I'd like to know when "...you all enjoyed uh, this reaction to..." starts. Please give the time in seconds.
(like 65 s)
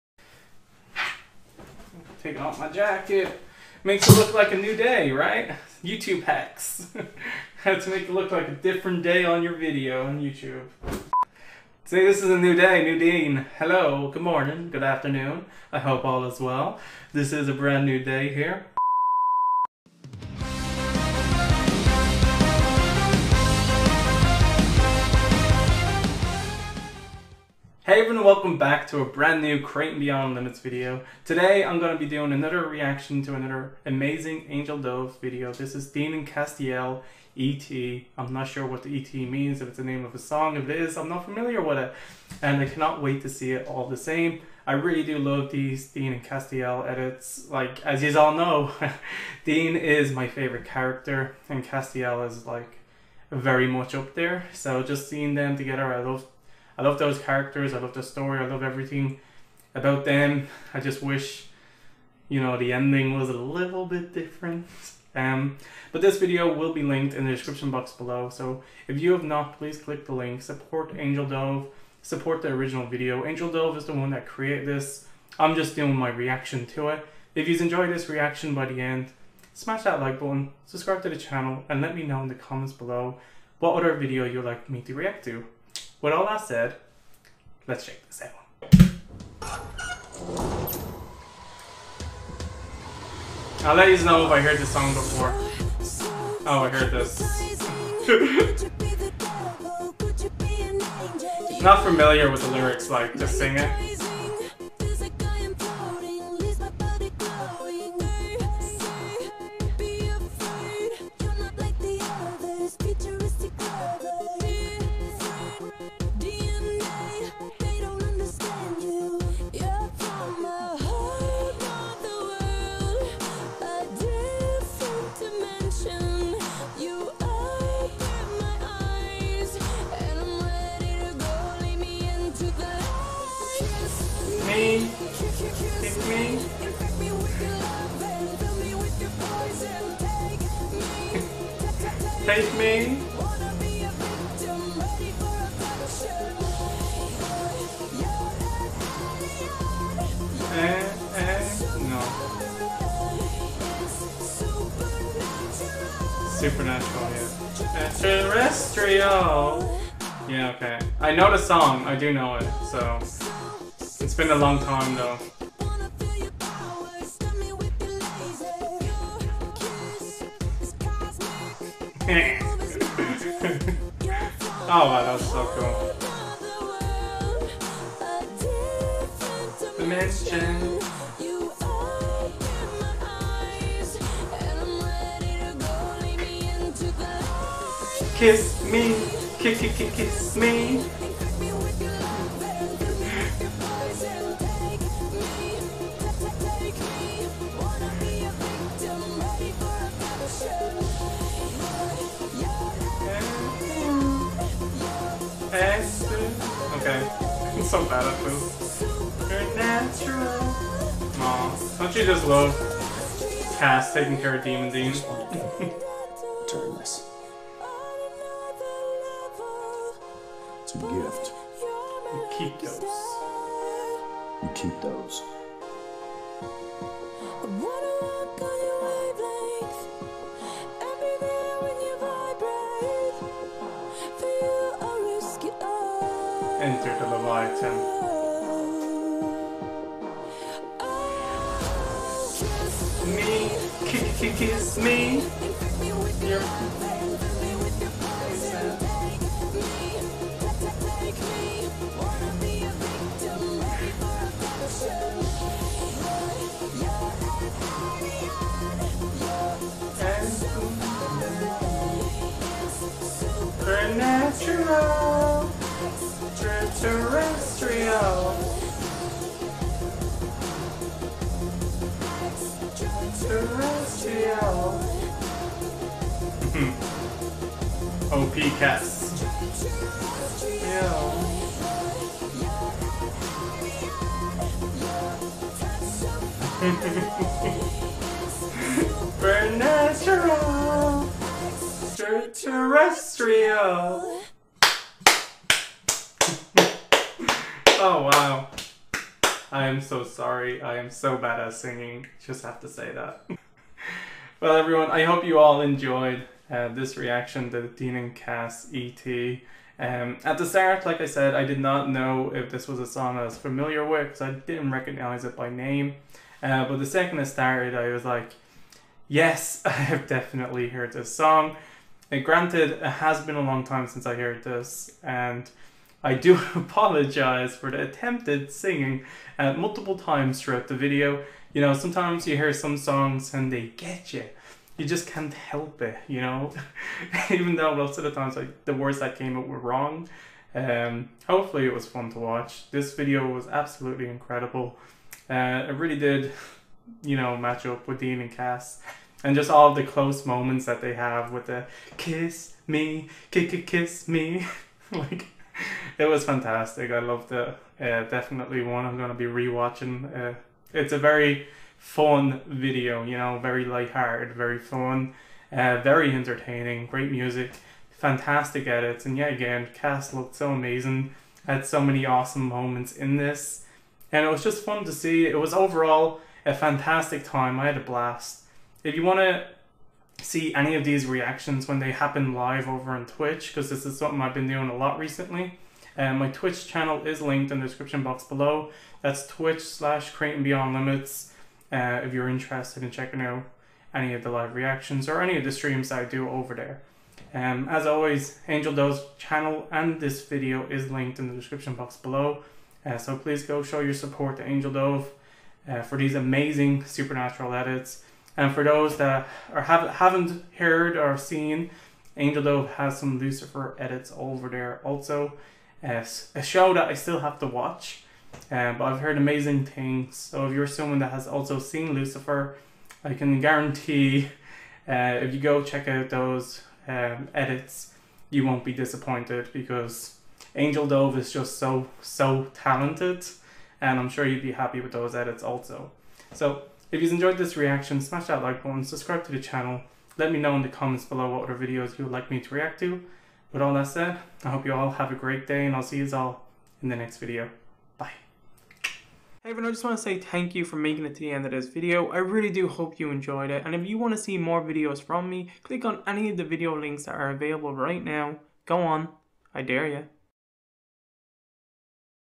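305 s.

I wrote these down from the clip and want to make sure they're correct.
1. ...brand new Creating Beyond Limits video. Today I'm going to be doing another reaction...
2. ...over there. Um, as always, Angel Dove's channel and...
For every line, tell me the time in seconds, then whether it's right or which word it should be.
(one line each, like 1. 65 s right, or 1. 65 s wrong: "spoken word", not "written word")
1. 29 s right
2. 396 s right.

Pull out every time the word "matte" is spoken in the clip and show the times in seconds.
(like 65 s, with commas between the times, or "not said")
not said.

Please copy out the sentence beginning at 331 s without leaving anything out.
You know, sometimes you hear some songs and they get you.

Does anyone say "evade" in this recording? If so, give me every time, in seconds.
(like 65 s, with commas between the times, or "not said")
not said.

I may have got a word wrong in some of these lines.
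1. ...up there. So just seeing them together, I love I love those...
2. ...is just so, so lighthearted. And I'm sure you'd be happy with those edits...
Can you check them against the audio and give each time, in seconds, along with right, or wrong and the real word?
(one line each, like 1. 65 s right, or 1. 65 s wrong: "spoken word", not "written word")
1. 53 s right
2. 431 s wrong: "talented", not "lighthearted".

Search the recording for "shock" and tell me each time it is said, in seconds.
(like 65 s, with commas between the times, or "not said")
not said.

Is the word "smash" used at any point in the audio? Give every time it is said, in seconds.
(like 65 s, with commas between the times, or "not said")
79 s, 438 s.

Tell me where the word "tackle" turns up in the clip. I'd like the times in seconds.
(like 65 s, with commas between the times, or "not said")
not said.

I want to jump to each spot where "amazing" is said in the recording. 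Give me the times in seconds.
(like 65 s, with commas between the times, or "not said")
33 s, 370 s, 406 s, 419 s.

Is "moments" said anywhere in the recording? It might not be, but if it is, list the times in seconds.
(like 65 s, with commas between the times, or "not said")
350 s, 372 s.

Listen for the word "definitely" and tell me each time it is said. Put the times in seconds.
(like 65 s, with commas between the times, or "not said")
320 s, 358 s.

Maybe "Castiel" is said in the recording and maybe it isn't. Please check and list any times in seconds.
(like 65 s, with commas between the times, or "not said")
36 s, 46 s, 51 s.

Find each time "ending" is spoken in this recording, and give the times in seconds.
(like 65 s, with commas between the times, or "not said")
62 s.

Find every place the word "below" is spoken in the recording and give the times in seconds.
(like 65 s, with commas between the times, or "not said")
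67 s, 82 s, 388 s, 401 s, 441 s.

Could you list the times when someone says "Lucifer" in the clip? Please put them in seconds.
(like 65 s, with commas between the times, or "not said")
413 s, 421 s.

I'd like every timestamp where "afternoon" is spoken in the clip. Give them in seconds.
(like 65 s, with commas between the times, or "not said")
14 s.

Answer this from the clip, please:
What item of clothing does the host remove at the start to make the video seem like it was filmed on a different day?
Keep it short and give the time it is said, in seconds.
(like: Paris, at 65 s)
Jacket, at 2 s.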